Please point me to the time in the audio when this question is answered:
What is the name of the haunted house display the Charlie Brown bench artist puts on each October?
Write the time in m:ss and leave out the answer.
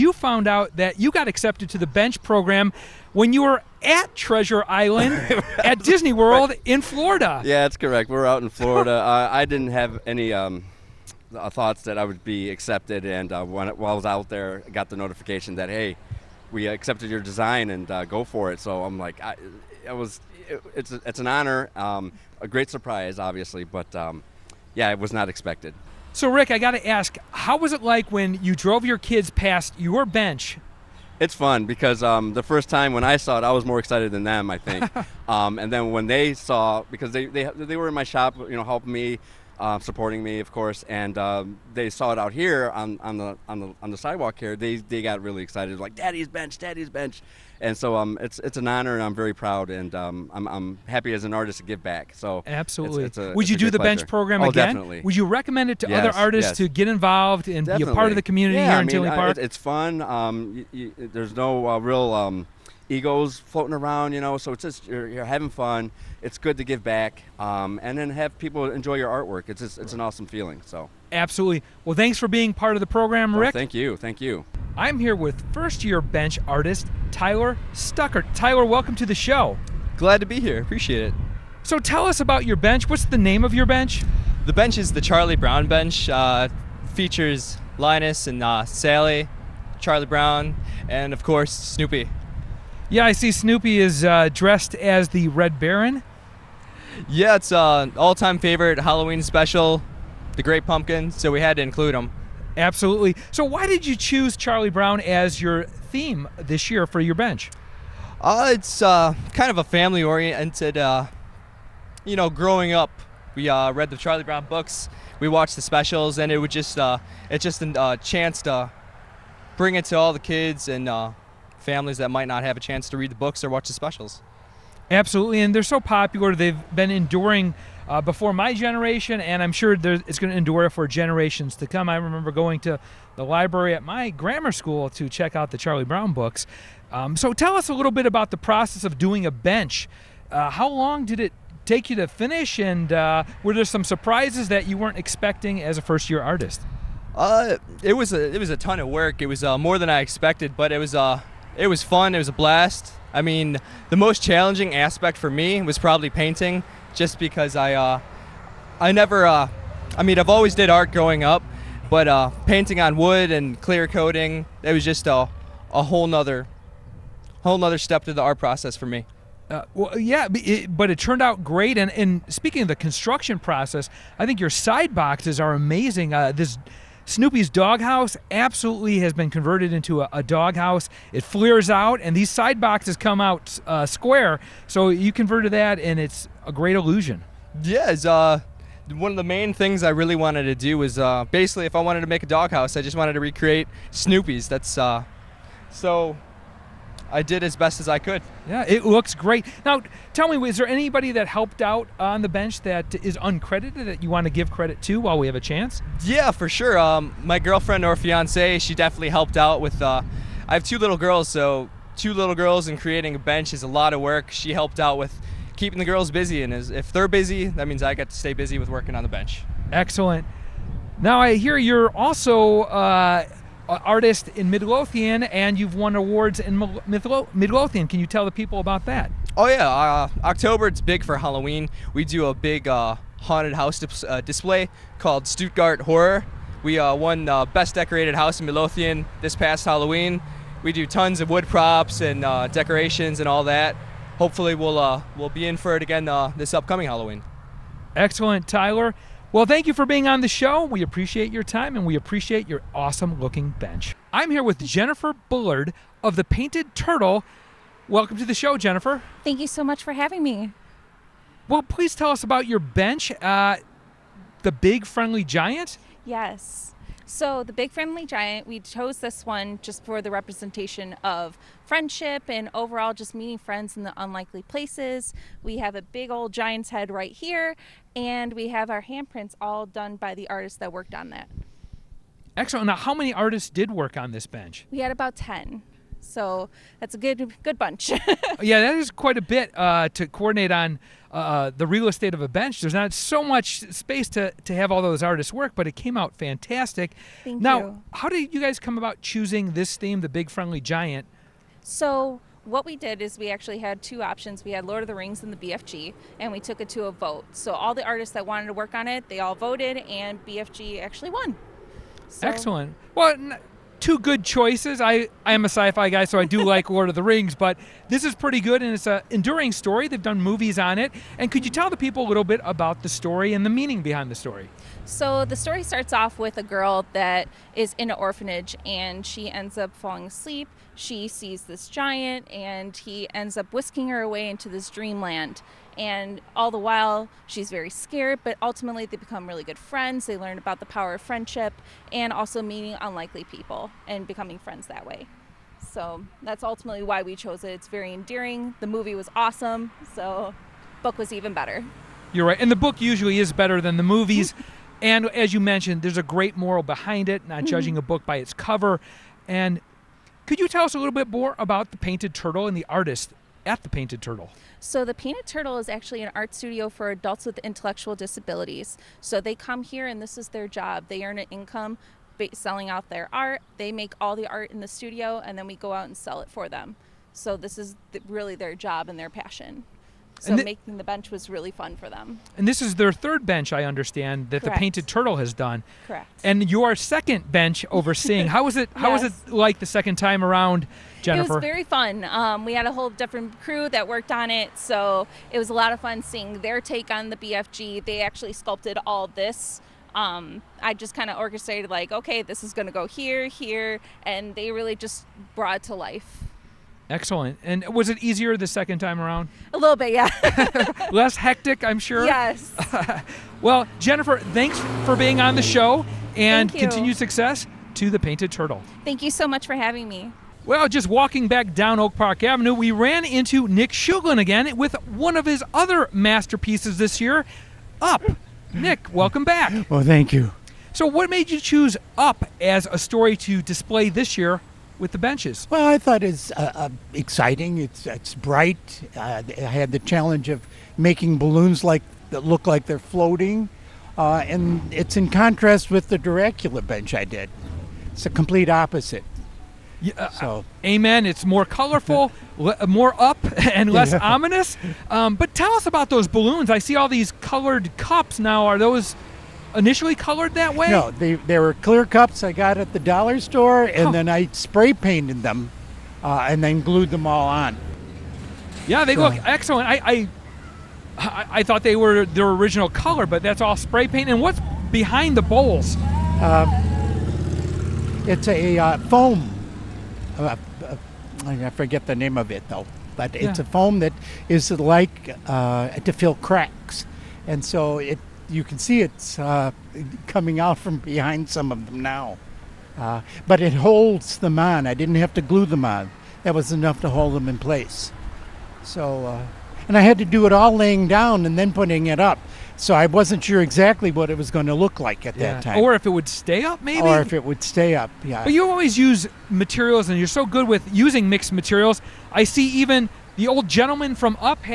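3:55.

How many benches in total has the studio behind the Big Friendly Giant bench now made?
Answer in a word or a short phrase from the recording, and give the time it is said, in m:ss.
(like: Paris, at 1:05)
3, at 6:22.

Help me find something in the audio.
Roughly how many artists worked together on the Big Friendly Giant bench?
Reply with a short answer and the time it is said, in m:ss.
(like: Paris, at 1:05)
10, at 4:44.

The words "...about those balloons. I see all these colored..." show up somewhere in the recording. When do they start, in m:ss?
7:35.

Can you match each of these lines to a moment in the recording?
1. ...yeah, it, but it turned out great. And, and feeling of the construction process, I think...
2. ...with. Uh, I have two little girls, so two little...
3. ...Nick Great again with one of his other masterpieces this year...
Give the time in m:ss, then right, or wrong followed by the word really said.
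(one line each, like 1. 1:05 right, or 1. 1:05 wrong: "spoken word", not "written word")
1. 2:49 wrong: "speaking", not "feeling"
2. 3:29 right
3. 7:03 wrong: "Shuglin", not "Great".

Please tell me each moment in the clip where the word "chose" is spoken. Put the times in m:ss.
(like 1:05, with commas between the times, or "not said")
4:28, 5:47.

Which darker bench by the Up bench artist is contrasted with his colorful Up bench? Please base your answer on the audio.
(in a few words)
Dracula.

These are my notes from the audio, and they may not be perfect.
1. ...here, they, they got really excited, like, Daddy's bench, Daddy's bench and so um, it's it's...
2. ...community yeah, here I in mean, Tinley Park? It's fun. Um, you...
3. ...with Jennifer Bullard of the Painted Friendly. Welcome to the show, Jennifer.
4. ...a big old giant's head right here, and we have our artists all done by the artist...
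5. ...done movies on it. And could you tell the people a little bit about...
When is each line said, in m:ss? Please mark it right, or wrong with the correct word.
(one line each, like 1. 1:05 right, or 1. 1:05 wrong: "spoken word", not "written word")
1. 0:44 right
2. 0:58 right
3. 4:14 wrong: "Turtle", not "Friendly"
4. 4:35 wrong: "handprints", not "artists"
5. 5:20 right.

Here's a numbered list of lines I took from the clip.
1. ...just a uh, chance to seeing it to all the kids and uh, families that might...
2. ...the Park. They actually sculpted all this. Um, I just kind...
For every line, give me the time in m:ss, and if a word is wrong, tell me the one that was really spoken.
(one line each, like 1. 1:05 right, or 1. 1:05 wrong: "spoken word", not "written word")
1. 1:57 wrong: "bring", not "seeing"
2. 6:37 wrong: "BFG", not "Park".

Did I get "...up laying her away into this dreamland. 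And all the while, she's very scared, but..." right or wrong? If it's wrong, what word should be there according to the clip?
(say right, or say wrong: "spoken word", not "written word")
wrong: "whisking", not "laying".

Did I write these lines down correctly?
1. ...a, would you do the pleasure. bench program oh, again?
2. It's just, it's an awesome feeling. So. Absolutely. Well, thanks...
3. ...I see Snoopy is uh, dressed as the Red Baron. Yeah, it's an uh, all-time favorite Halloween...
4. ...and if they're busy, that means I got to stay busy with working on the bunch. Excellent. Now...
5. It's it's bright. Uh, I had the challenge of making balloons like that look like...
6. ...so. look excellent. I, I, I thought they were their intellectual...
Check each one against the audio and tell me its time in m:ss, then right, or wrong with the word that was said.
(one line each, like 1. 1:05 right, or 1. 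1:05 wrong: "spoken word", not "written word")
1. 0:53 right
2. 1:09 right
3. 1:33 right
4. 3:36 wrong: "bench", not "bunch"
5. 7:17 right
6. 7:48 wrong: "original", not "intellectual".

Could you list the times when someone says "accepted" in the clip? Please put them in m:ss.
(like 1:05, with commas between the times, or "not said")
0:01, 0:12, 0:16.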